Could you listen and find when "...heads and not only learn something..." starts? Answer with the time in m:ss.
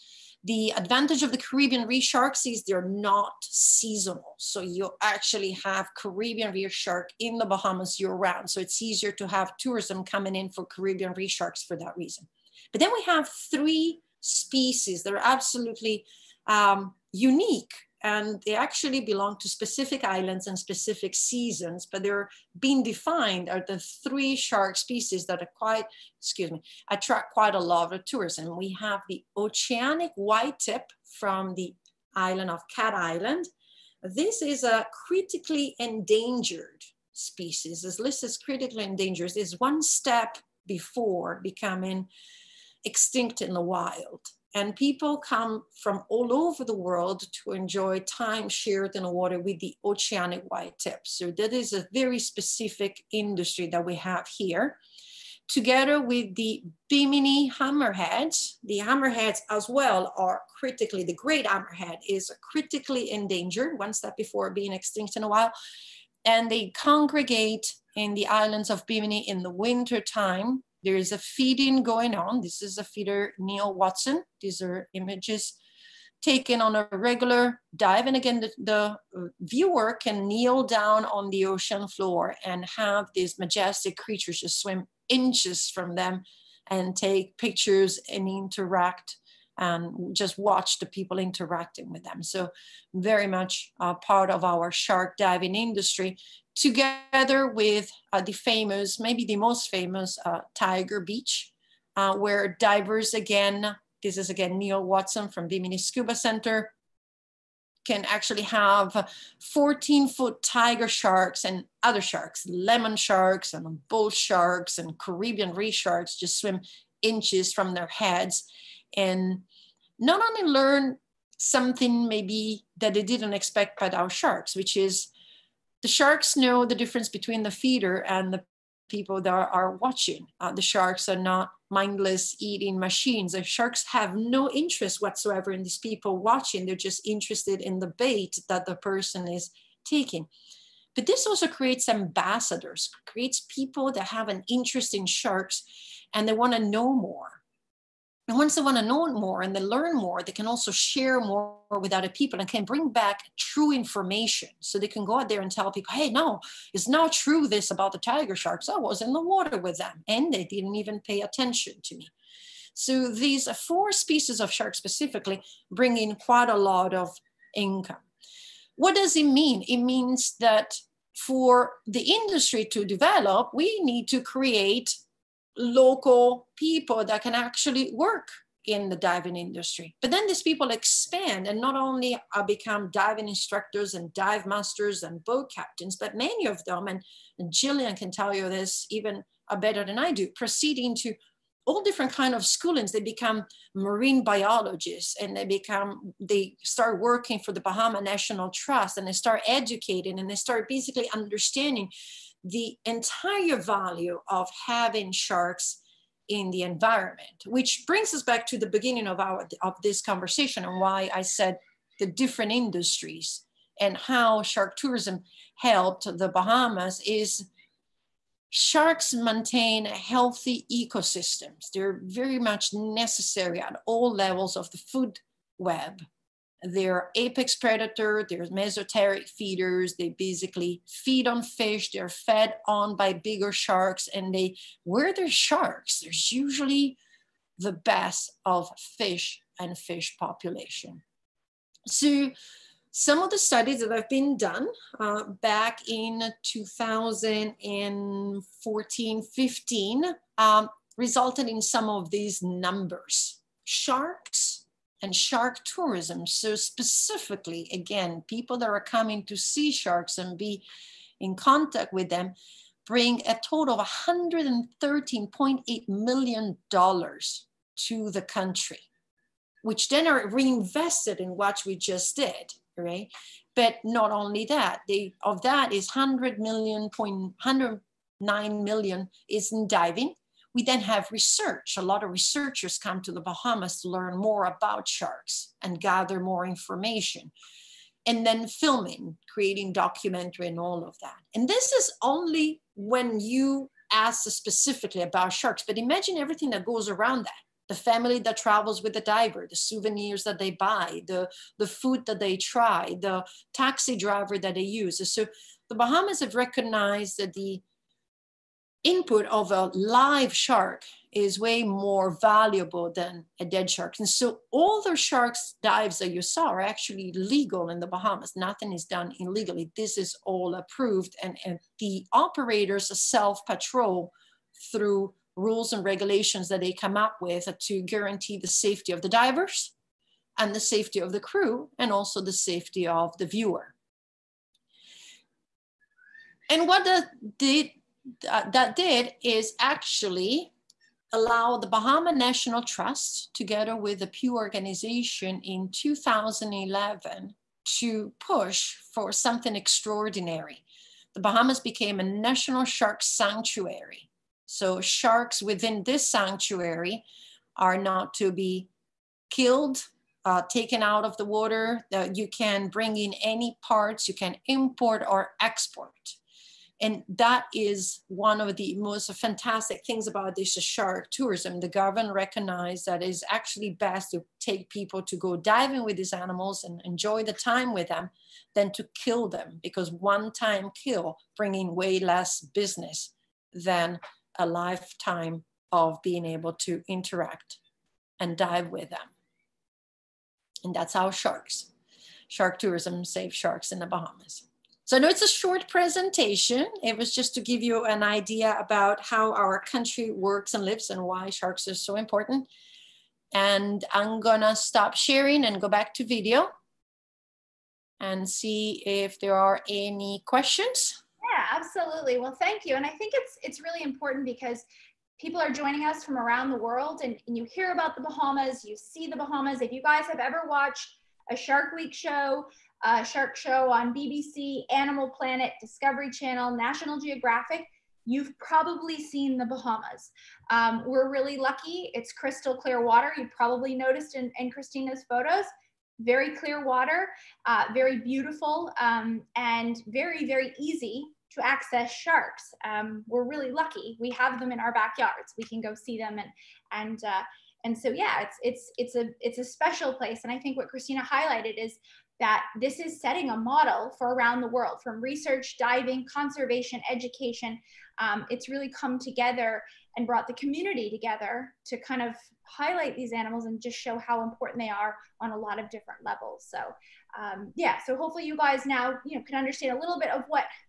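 1:57.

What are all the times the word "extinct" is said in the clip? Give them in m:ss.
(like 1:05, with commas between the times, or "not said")
0:42, 1:04.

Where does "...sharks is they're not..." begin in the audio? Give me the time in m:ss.
0:02.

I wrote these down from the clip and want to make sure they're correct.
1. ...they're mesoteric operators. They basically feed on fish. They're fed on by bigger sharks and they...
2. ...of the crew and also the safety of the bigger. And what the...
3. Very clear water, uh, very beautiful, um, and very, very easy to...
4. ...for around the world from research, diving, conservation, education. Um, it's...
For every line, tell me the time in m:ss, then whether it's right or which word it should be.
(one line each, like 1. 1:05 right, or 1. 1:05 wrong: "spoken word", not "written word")
1. 3:48 wrong: "feeders", not "operators"
2. 5:30 wrong: "viewer", not "bigger"
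3. 7:16 right
4. 7:33 right.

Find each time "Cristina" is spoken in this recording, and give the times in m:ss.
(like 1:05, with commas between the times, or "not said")
7:14, 7:30.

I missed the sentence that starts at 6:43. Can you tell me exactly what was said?
And I'm gonna stop sharing and go back to video and see if there are any questions.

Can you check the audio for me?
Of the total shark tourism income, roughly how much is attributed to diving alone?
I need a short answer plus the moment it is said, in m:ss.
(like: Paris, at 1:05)
109 million, at 4:37.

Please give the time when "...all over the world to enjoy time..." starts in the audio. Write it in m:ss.
0:46.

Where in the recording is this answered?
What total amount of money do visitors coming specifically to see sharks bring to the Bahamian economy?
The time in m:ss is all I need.
4:23.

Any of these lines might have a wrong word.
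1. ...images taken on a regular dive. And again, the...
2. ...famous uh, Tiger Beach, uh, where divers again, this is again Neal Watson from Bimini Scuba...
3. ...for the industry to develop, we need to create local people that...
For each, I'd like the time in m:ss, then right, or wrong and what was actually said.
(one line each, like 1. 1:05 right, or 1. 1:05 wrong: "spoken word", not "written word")
1. 1:14 right
2. 1:39 right
3. 2:51 right.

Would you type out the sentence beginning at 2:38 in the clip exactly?
I was in the water with them and they didn't even pay attention to me.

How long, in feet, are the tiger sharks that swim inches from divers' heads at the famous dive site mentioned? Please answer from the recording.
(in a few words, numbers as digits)
14 foot.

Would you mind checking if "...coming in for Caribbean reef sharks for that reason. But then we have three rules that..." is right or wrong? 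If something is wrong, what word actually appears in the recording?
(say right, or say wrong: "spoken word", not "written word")
wrong: "species", not "rules".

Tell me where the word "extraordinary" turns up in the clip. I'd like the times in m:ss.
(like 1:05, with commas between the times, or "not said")
5:49.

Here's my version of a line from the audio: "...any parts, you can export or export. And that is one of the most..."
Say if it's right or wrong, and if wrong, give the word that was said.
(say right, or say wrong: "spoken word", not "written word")
wrong: "import", not "export".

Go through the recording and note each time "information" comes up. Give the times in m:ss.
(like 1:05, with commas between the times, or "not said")
2:33, 4:46.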